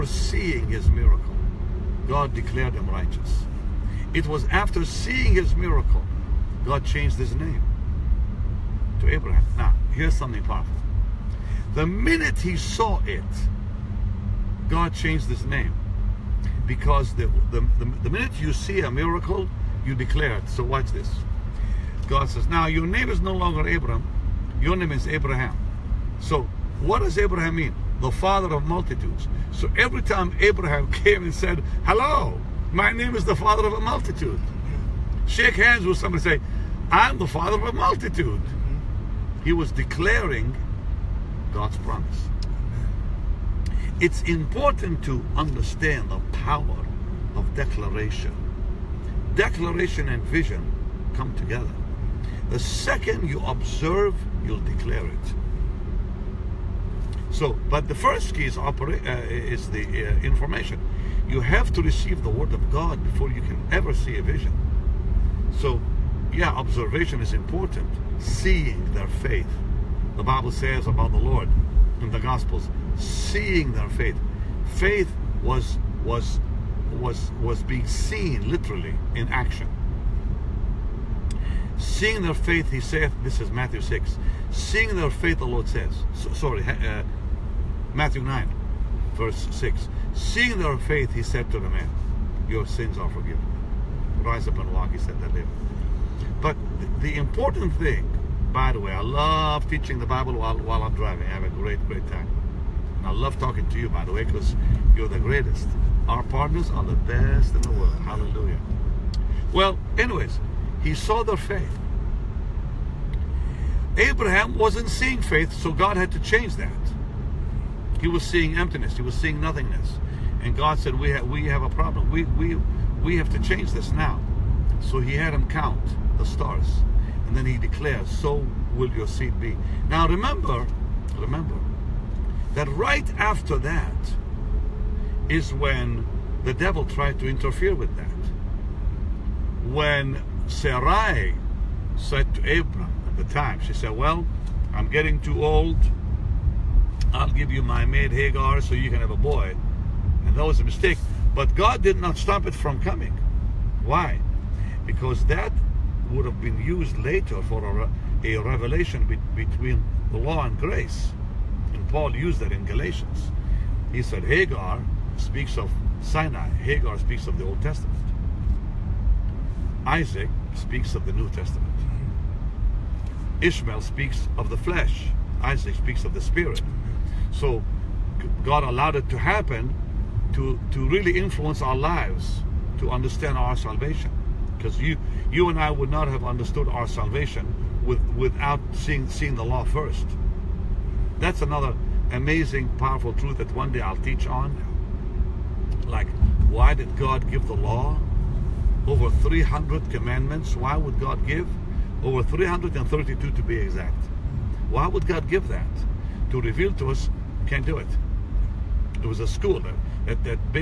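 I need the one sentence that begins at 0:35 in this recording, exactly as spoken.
Shake hands with somebody say, I'm the father of a multitude.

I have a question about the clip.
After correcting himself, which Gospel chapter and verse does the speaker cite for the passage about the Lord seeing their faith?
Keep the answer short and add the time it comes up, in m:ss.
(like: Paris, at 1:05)
Matthew 9:6, at 1:27.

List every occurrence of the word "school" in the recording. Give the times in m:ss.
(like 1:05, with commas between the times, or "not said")
3:29.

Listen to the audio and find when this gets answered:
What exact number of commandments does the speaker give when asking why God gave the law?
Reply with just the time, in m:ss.
3:22.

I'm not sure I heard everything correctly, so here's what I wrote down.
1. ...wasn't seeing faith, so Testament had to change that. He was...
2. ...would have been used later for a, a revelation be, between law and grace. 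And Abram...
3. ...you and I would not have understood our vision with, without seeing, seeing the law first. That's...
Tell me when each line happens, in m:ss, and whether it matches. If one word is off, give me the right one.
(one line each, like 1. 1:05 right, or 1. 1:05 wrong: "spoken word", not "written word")
1. 1:54 wrong: "God", not "Testament"
2. 2:36 wrong: "Paul", not "Abram"
3. 3:05 wrong: "salvation", not "vision".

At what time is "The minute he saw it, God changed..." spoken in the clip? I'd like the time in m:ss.
0:11.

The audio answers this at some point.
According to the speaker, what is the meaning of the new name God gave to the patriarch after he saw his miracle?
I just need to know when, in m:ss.
0:28.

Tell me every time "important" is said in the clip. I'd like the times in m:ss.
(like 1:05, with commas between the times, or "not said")
0:44, 1:07, 1:37.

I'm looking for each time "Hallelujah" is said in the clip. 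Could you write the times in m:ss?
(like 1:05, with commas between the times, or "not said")
1:48.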